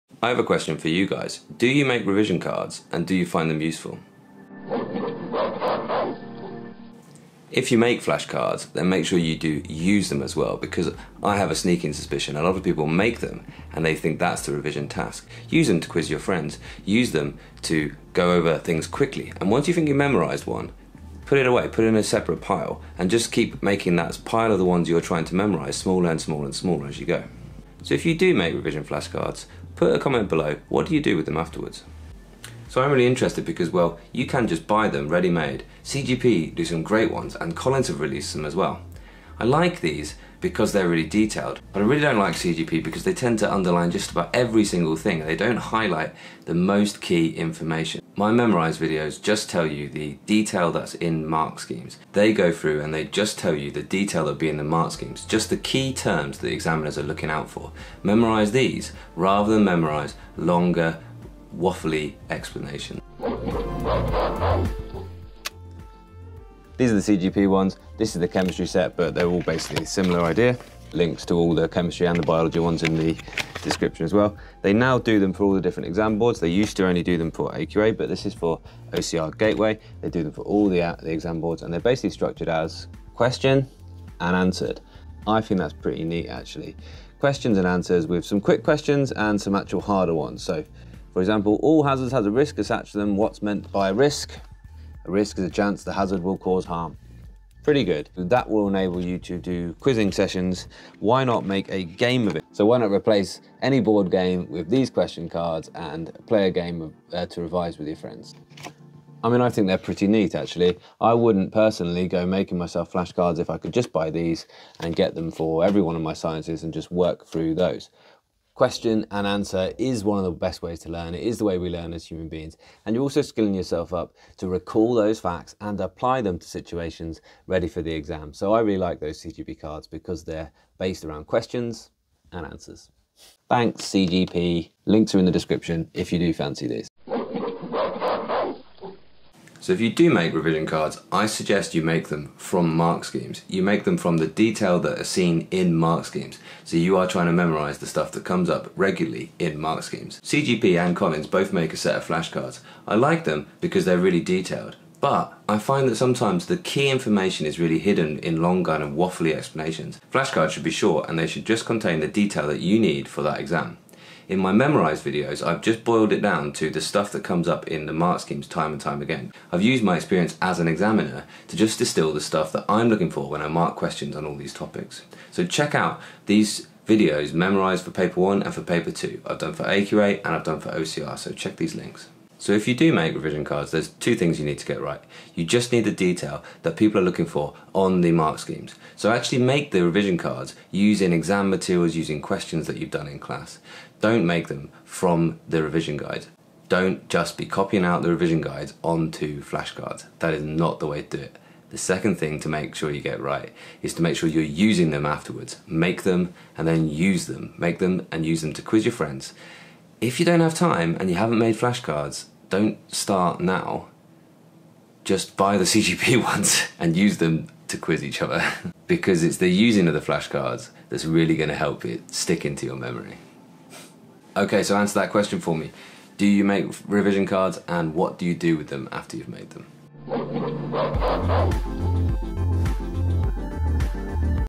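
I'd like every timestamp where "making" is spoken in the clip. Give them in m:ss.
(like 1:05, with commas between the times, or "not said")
0:23, 1:52.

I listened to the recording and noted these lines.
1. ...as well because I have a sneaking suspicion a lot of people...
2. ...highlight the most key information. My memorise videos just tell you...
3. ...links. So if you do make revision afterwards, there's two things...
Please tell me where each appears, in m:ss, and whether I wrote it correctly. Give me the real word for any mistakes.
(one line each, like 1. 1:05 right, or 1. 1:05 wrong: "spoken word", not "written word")
1. 0:10 right
2. 0:45 right
3. 3:01 wrong: "cards", not "afterwards".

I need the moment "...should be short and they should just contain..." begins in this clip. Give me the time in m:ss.
2:40.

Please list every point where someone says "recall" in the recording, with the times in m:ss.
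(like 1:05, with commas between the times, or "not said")
2:04.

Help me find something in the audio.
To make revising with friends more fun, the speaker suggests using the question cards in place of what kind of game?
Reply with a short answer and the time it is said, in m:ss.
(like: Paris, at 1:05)
board game, at 1:43.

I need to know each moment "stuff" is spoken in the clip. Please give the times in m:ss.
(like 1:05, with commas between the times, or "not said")
2:27, 2:46, 2:52.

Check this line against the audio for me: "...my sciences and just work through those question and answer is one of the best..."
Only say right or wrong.
right.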